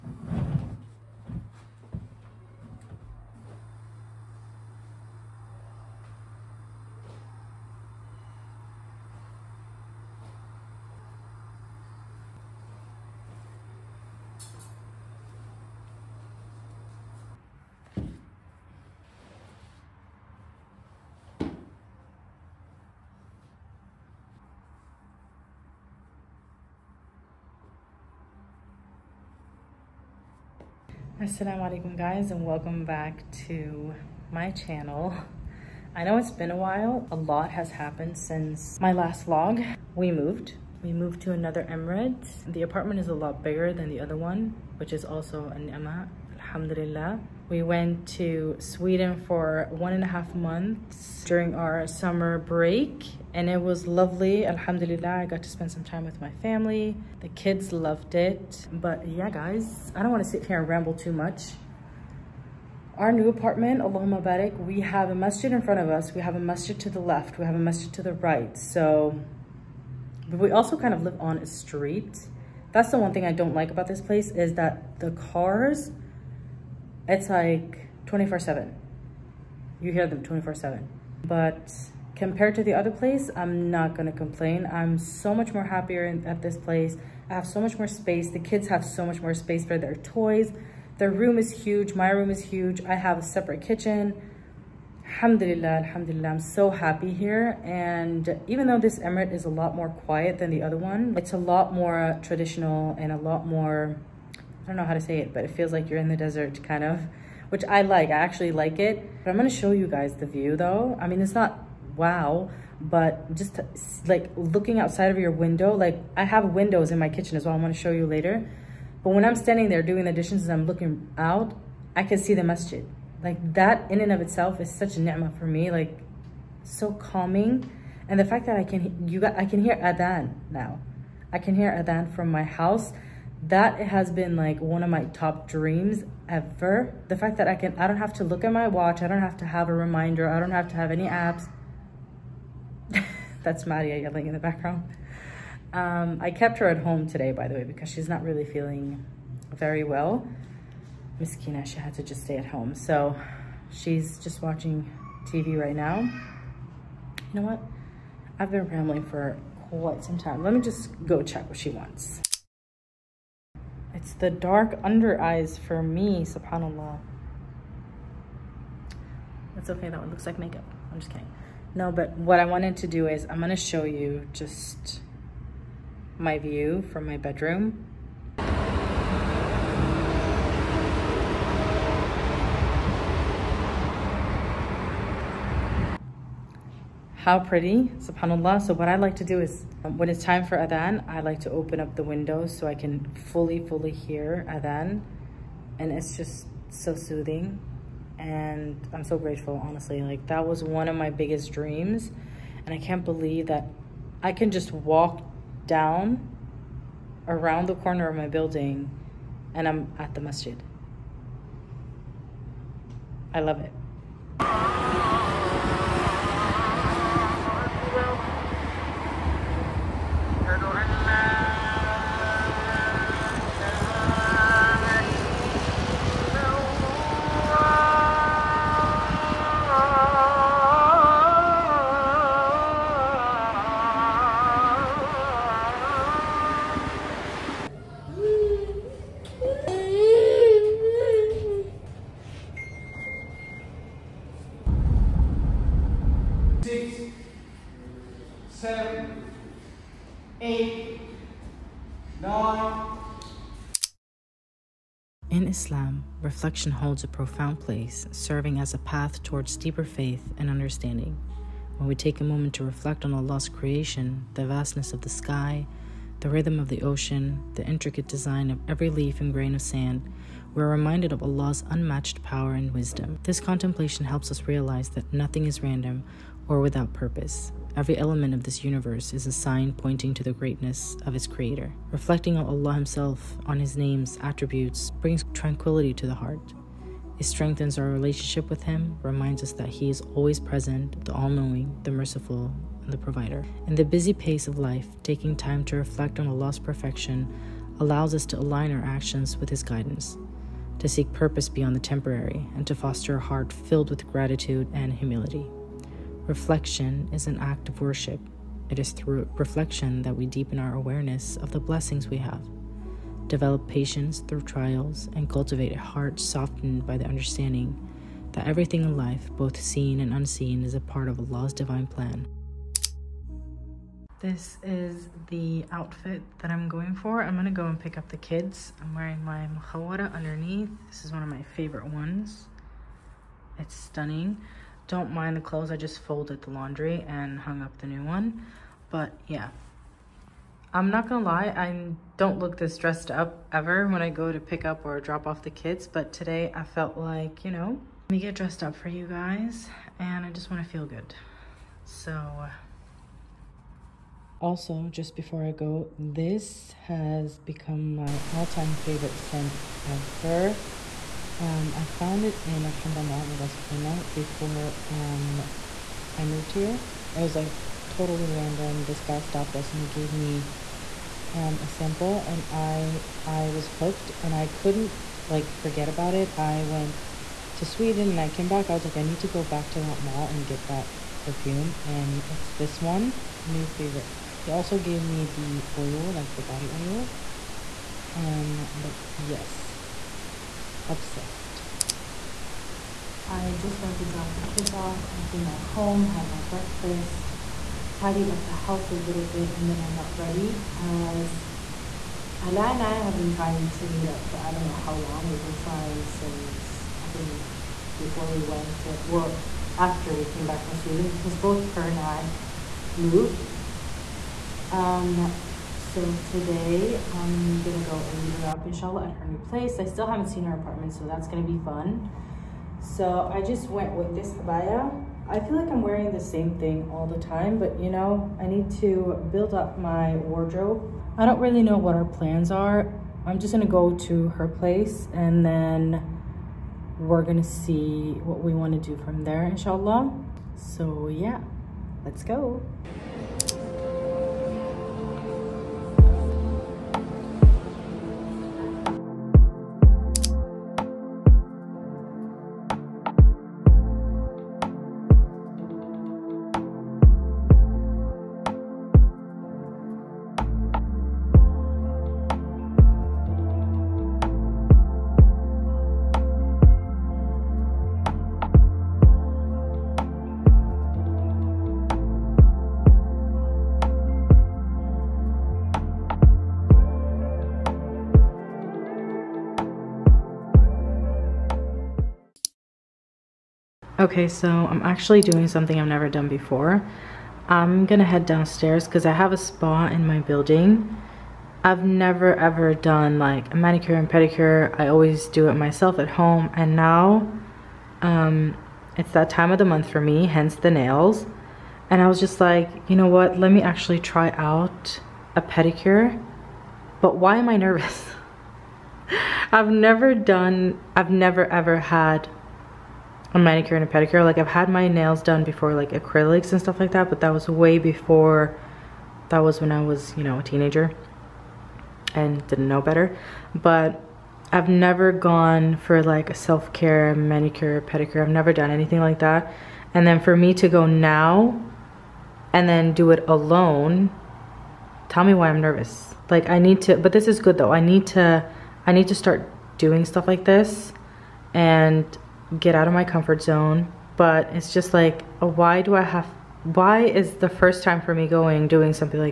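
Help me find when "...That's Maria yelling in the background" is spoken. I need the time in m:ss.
2:23.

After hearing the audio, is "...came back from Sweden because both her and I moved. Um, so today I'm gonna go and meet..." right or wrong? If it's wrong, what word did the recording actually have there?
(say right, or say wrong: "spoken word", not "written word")
right.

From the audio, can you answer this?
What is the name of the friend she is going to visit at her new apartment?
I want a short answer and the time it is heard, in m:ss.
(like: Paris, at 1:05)
Ala, at 6:42.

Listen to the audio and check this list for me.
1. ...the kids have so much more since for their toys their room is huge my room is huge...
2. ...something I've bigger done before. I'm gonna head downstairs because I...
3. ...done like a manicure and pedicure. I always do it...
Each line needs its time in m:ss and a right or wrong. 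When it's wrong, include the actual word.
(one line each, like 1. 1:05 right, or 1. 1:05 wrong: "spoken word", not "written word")
1. 1:28 wrong: "space", not "since"
2. 8:05 wrong: "never", not "bigger"
3. 8:12 right.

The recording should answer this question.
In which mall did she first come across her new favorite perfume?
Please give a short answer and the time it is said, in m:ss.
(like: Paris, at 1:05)
Al Hamra Mall, at 6:02.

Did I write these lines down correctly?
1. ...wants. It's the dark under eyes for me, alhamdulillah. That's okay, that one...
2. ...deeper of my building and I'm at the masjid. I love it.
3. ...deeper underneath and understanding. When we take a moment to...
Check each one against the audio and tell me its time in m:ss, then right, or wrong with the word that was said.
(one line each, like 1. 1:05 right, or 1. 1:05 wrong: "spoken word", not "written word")
1. 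2:41 wrong: "subhanAllah", not "alhamdulillah"
2. 3:27 wrong: "corner", not "deeper"
3. 4:19 wrong: "faith", not "underneath".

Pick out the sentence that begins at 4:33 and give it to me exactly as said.
This contemplation helps us realize that nothing is random or without purpose.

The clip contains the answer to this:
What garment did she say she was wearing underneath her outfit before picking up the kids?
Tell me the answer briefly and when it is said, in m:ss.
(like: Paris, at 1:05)
Mukhawara, at 5:29.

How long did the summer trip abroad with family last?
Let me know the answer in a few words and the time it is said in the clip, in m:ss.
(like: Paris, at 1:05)
One and a half months, at 0:49.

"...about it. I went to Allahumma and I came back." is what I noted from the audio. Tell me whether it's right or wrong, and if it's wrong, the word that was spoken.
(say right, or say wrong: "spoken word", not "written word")
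wrong: "Sweden", not "Allahumma".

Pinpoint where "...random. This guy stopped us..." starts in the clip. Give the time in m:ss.
6:08.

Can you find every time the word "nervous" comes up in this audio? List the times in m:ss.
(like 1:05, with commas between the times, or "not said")
8:27, 8:55.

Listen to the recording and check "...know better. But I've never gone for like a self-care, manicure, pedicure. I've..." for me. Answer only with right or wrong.
right.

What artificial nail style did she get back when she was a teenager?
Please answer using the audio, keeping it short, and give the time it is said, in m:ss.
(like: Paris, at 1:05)
Acrylics, at 8:35.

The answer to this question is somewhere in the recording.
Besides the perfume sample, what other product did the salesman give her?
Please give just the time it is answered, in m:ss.
6:26.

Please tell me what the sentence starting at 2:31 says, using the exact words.
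Miss Kina, she had to just stay at home.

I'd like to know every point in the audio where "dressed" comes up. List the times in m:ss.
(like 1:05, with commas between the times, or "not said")
5:42, 5:48.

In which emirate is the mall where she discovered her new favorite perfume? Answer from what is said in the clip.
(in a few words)
Ras Al Khaimah.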